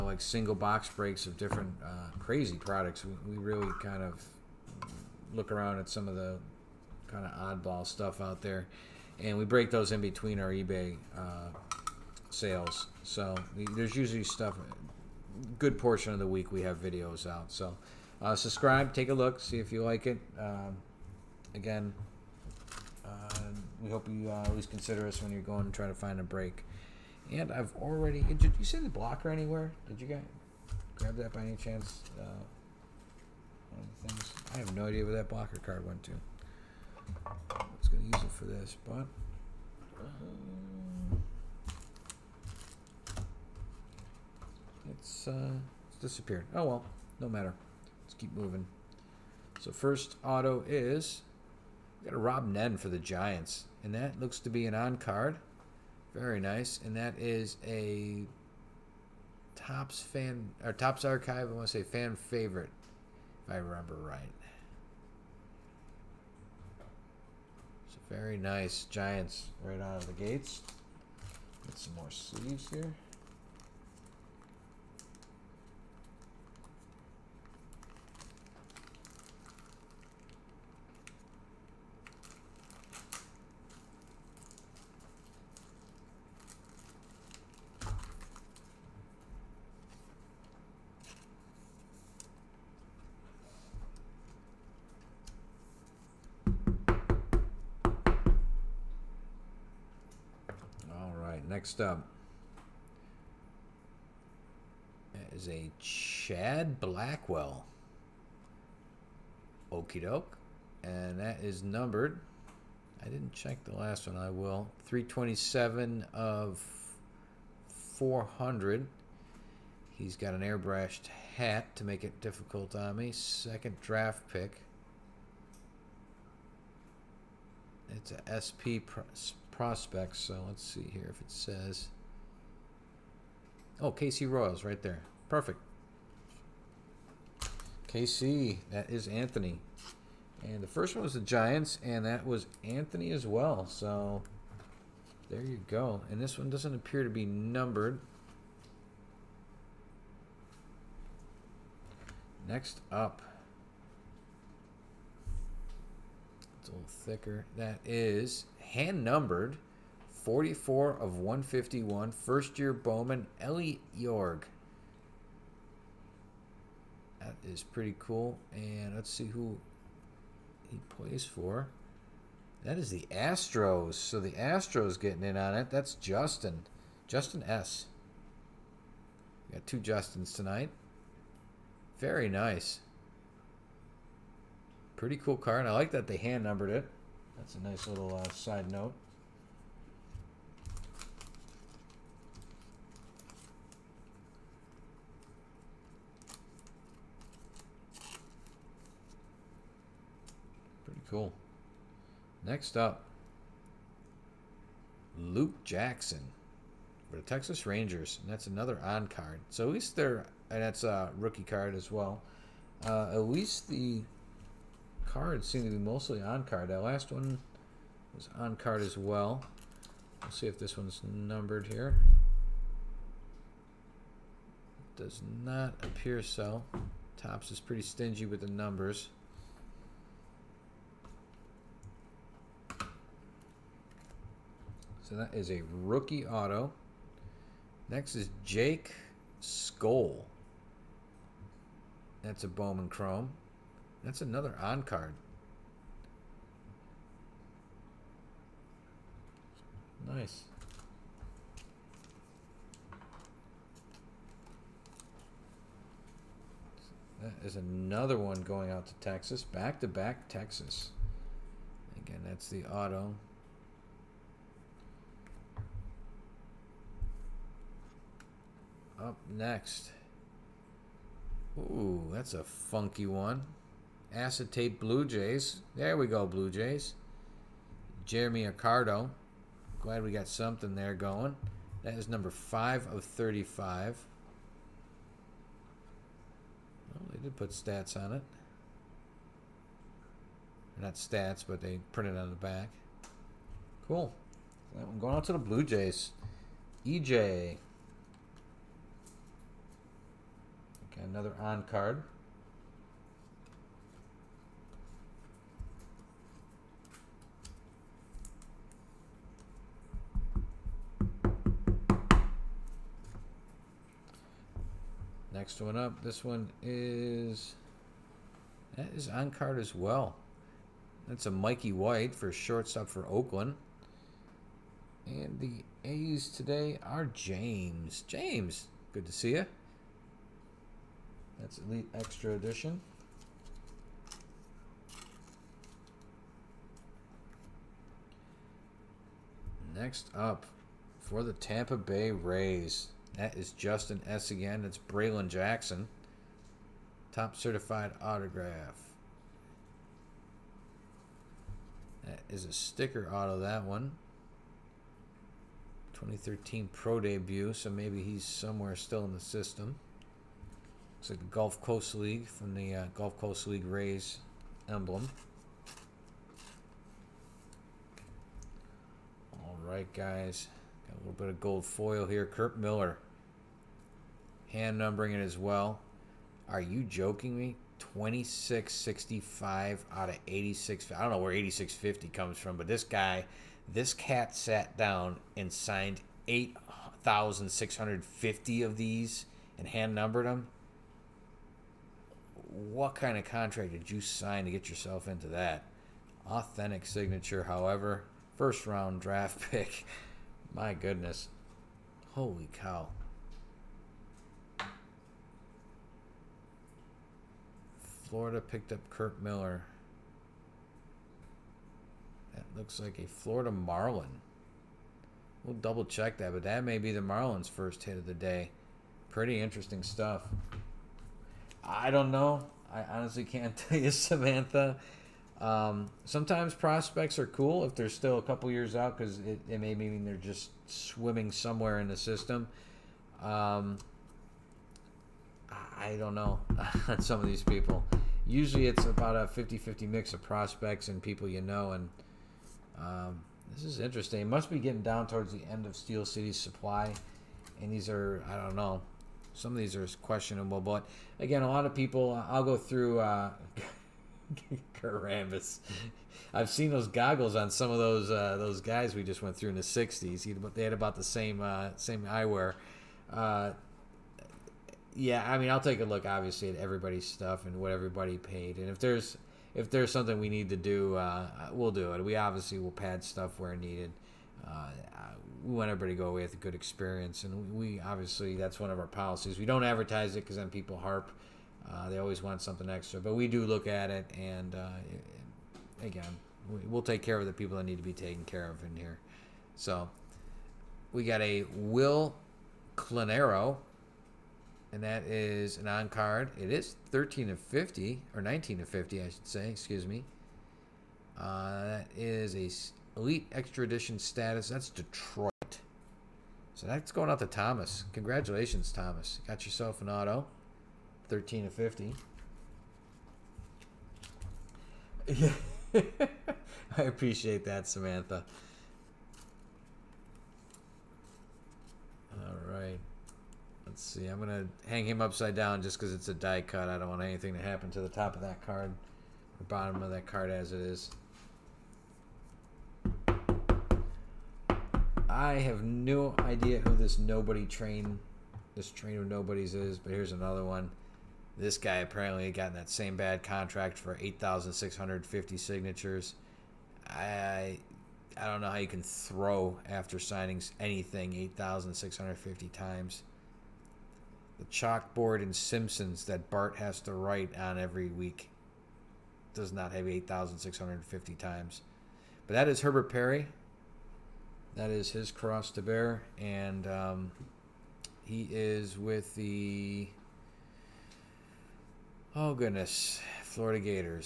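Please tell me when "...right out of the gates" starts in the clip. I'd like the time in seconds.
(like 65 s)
69 s.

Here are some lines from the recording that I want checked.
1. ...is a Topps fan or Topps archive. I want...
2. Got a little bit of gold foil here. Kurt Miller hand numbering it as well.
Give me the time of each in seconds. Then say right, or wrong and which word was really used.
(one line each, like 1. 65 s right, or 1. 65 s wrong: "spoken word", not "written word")
1. 57 s right
2. 370 s right.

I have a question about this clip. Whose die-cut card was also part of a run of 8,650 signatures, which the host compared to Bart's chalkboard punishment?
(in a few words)
Herbert Perry.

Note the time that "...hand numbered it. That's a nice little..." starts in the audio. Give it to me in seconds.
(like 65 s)
186 s.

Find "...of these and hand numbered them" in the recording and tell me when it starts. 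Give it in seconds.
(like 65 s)
388 s.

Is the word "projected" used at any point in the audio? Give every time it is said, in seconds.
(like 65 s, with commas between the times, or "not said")
not said.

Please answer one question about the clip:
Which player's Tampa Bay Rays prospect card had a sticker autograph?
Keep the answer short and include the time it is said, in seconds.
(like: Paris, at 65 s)
Braylon Jackson, at 344 s.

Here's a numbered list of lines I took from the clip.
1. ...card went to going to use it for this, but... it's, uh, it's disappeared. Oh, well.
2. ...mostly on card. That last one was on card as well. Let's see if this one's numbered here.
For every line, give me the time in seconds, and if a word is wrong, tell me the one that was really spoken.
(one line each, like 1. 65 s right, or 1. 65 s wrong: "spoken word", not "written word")
1. 35 s right
2. 215 s right.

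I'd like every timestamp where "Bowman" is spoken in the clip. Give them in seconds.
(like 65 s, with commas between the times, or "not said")
162 s, 242 s.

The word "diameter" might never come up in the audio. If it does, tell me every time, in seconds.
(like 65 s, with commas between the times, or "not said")
not said.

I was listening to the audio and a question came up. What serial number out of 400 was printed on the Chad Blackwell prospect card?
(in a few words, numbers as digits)
327.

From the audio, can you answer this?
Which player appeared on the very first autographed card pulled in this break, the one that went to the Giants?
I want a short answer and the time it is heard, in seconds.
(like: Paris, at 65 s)
Rob Nen, at 52 s.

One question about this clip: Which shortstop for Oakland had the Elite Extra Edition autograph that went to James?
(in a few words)
Mikey White.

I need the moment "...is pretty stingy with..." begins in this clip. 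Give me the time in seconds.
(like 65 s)
227 s.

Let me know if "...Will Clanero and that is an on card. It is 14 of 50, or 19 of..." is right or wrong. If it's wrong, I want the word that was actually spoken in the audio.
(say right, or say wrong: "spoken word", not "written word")
wrong: "13", not "14".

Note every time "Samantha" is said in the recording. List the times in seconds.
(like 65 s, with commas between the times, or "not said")
423 s, 517 s.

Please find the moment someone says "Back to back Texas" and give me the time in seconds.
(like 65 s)
259 s.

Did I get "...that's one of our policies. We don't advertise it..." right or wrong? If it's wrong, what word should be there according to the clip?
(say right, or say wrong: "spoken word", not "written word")
right.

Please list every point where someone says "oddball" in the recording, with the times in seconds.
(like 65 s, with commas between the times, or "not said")
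7 s.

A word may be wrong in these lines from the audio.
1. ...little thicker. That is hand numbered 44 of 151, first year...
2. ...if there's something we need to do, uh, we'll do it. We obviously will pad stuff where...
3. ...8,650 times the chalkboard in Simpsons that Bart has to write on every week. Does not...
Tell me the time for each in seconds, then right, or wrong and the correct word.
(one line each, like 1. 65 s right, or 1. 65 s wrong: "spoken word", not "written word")
1. 156 s right
2. 469 s right
3. 551 s right.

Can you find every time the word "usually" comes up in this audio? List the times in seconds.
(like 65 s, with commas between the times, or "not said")
13 s, 438 s.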